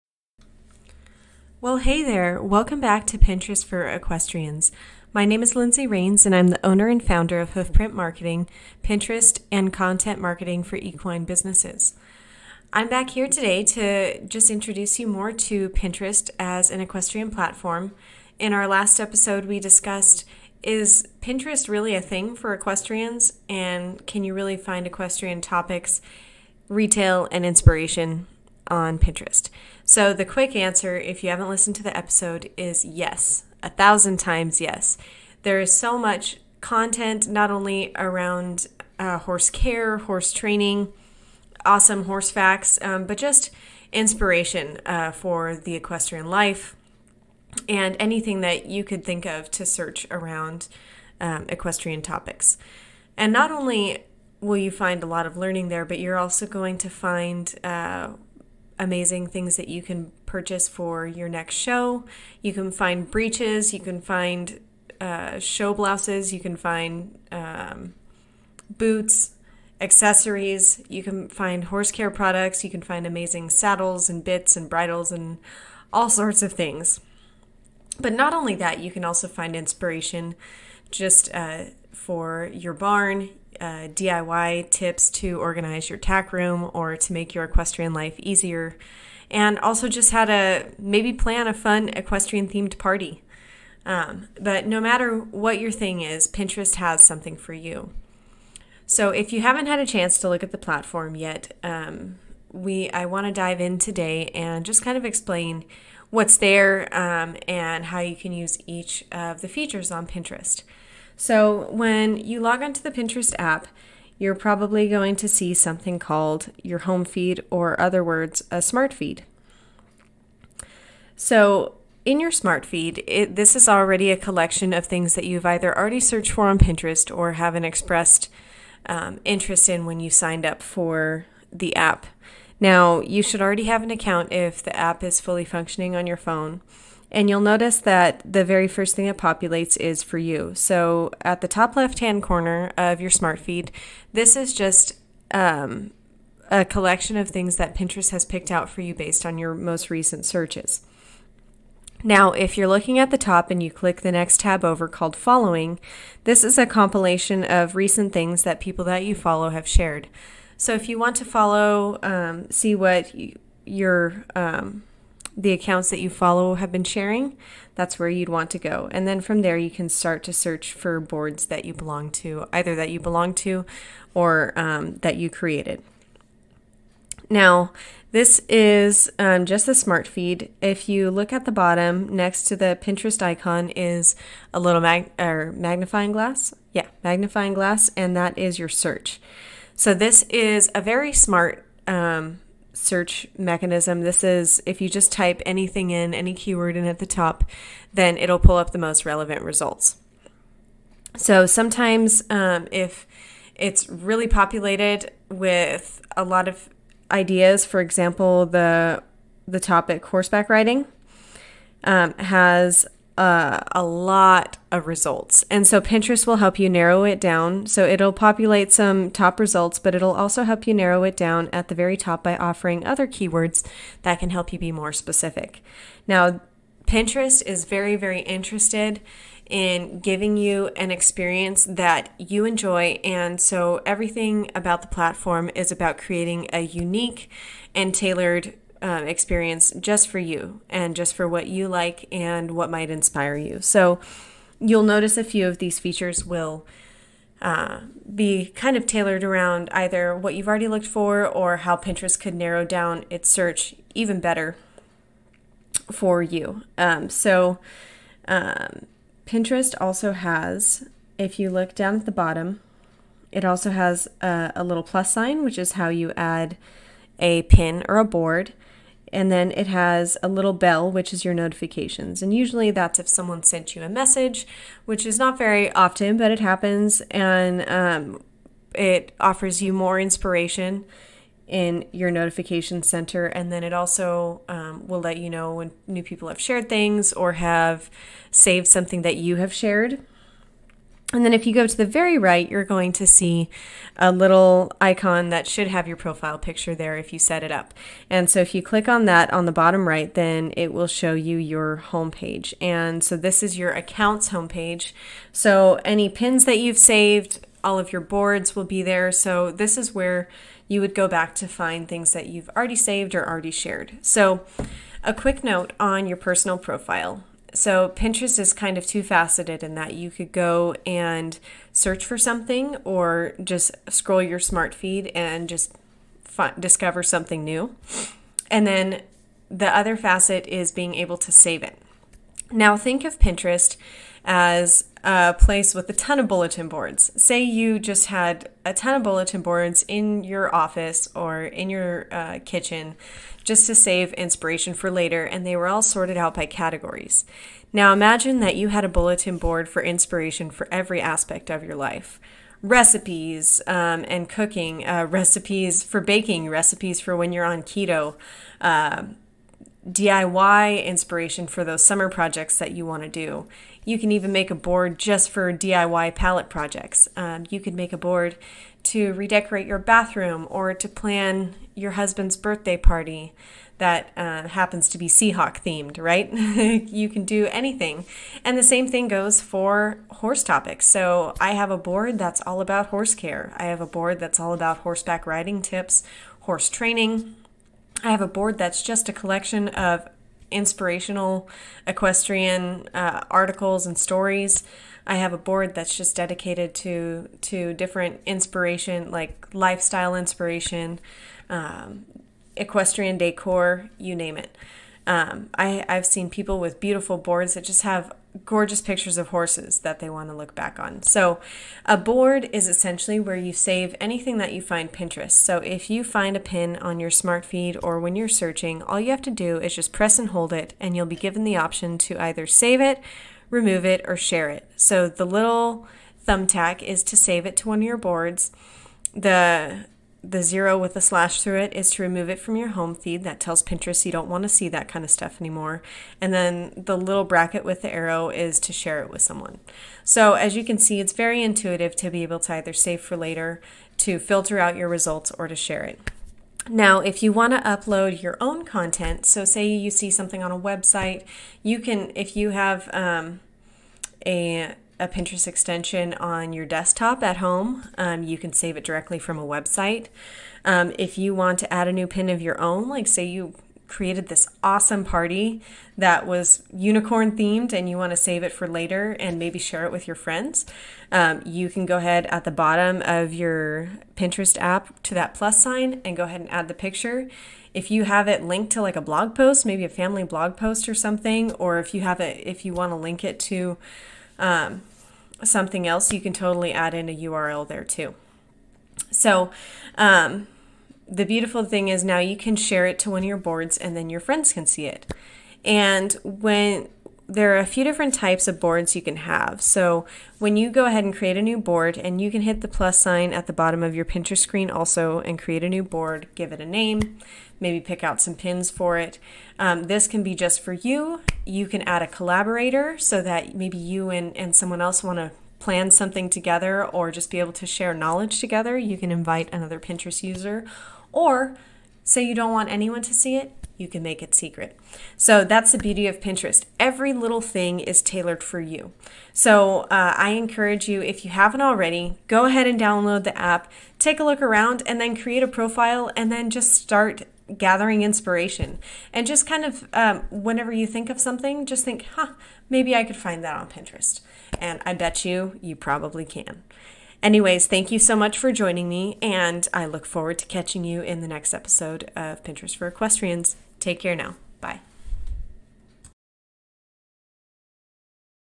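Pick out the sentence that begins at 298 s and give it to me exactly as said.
And so if you click on that on the bottom right, then it will show you your home page.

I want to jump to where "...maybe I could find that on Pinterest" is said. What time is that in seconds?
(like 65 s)
542 s.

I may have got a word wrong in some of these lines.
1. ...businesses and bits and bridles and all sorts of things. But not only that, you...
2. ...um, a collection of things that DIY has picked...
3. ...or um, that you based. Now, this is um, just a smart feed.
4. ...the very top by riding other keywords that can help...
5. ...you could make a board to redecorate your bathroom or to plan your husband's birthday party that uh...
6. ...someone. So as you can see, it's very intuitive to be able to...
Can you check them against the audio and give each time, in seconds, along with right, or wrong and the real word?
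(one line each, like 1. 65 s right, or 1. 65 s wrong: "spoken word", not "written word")
1. 73 s wrong: "saddles", not "businesses"
2. 145 s wrong: "Pinterest", not "DIY"
3. 174 s wrong: "created", not "based"
4. 221 s wrong: "offering", not "riding"
5. 367 s right
6. 439 s right.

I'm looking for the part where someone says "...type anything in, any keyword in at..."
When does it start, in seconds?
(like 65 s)
195 s.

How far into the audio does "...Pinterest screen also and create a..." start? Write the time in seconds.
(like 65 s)
504 s.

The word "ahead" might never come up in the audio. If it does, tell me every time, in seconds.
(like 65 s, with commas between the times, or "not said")
471 s, 476 s, 500 s, 532 s.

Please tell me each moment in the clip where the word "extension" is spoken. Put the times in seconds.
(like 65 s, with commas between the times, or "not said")
455 s.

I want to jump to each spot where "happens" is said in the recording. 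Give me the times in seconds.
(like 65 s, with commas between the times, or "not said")
276 s, 374 s.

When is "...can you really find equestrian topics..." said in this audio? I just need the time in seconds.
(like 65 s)
24 s.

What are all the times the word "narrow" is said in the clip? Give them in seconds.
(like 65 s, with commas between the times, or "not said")
216 s, 220 s, 252 s.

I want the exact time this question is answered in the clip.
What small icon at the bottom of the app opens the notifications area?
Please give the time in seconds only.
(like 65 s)
270 s.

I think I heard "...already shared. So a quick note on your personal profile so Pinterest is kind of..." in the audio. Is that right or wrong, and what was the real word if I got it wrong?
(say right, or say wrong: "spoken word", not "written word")
right.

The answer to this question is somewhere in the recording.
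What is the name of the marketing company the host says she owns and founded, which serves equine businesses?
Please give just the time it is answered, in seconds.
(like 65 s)
7 s.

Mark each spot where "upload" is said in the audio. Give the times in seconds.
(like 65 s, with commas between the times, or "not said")
447 s.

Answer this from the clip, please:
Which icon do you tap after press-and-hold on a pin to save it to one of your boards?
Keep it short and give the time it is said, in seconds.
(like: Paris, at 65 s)
thumbtack, at 426 s.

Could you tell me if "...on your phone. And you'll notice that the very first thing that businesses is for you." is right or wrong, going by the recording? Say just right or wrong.
wrong.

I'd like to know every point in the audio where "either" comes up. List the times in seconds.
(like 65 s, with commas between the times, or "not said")
125 s, 172 s, 249 s, 422 s, 442 s.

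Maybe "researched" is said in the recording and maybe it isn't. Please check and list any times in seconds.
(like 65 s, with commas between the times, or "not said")
not said.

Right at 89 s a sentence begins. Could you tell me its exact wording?
And also just how to maybe plan a fun equestrian themed party.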